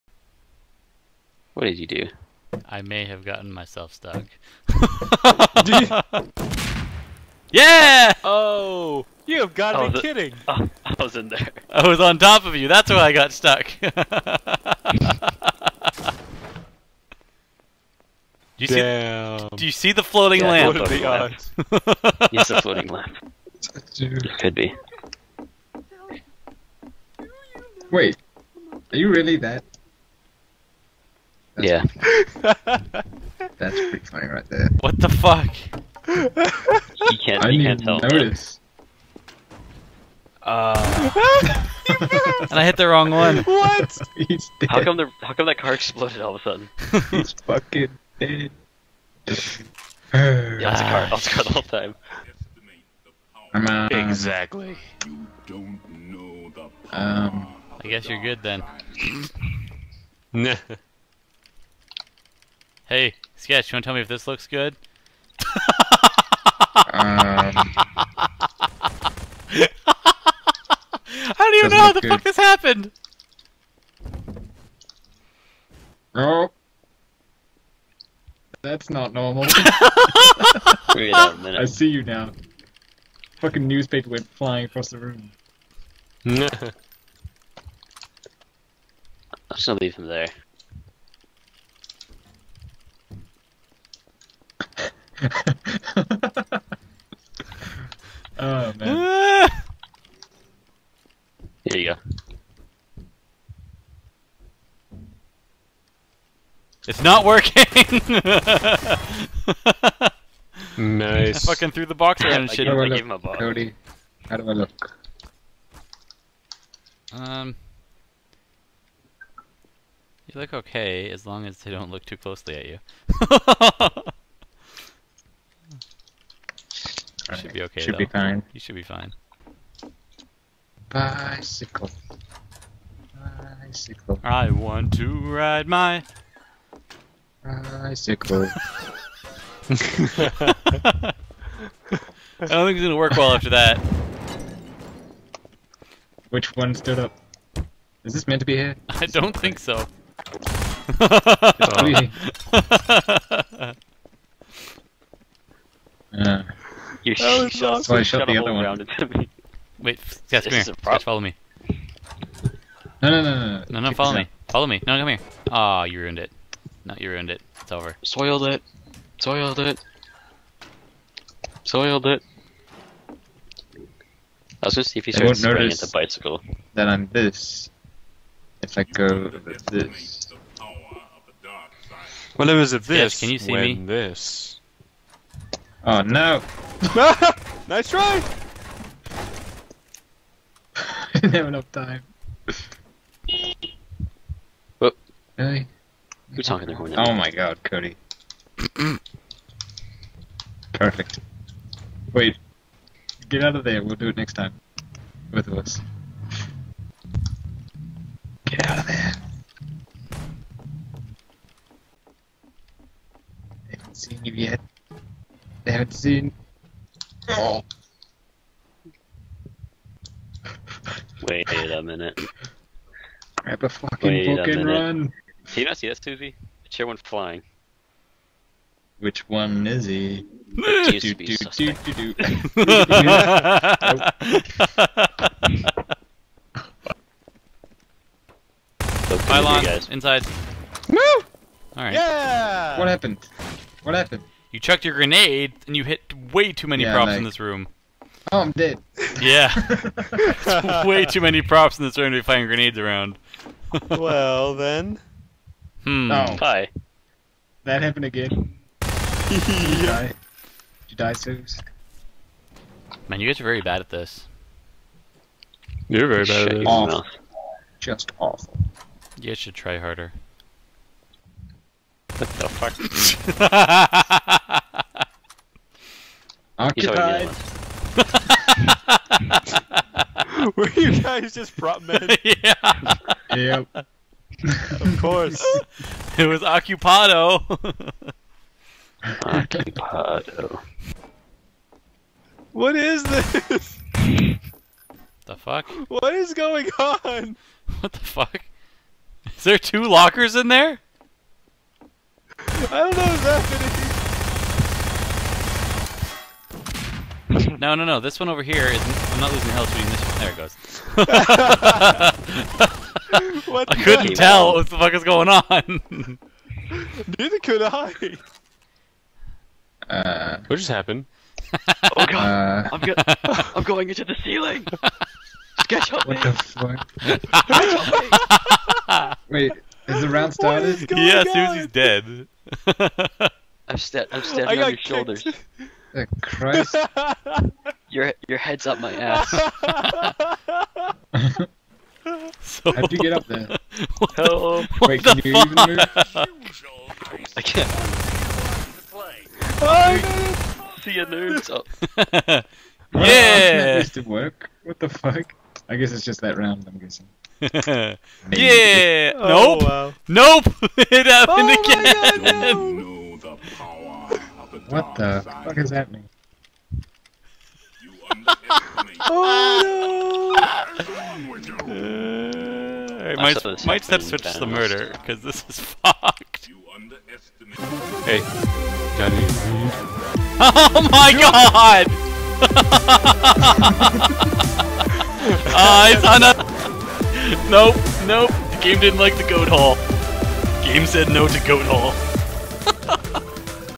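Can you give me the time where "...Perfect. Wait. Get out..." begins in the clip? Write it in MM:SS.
03:20.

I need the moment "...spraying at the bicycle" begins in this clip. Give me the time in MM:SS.
02:55.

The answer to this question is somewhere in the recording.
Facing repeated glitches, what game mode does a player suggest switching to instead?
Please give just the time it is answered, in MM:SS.
06:14.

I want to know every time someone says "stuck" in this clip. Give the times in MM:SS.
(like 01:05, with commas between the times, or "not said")
00:03, 00:13.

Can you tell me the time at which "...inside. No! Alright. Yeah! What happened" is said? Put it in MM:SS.
03:59.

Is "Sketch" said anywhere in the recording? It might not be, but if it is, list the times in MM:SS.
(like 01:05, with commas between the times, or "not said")
01:03, 05:25.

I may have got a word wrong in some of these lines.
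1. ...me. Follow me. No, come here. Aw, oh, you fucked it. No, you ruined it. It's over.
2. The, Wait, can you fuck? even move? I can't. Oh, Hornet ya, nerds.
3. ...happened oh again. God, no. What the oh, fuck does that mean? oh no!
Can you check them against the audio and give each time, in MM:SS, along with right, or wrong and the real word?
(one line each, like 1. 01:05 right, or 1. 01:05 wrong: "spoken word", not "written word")
1. 02:44 wrong: "ruined", not "fucked"
2. 05:44 wrong: "See", not "Hornet"
3. 06:01 right.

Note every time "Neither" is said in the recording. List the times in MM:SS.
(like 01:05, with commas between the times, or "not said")
05:17.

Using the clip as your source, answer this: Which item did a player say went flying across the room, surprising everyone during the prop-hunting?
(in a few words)
Newspaper.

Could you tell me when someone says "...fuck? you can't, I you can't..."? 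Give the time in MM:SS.
00:35.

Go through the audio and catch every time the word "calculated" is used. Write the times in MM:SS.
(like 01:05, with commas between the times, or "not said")
not said.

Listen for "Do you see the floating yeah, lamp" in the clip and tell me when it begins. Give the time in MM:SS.
00:19.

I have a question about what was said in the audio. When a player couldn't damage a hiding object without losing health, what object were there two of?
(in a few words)
Lockers.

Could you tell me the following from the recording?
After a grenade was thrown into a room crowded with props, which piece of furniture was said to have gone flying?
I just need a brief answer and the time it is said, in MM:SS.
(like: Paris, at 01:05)
The Chair, at 03:46.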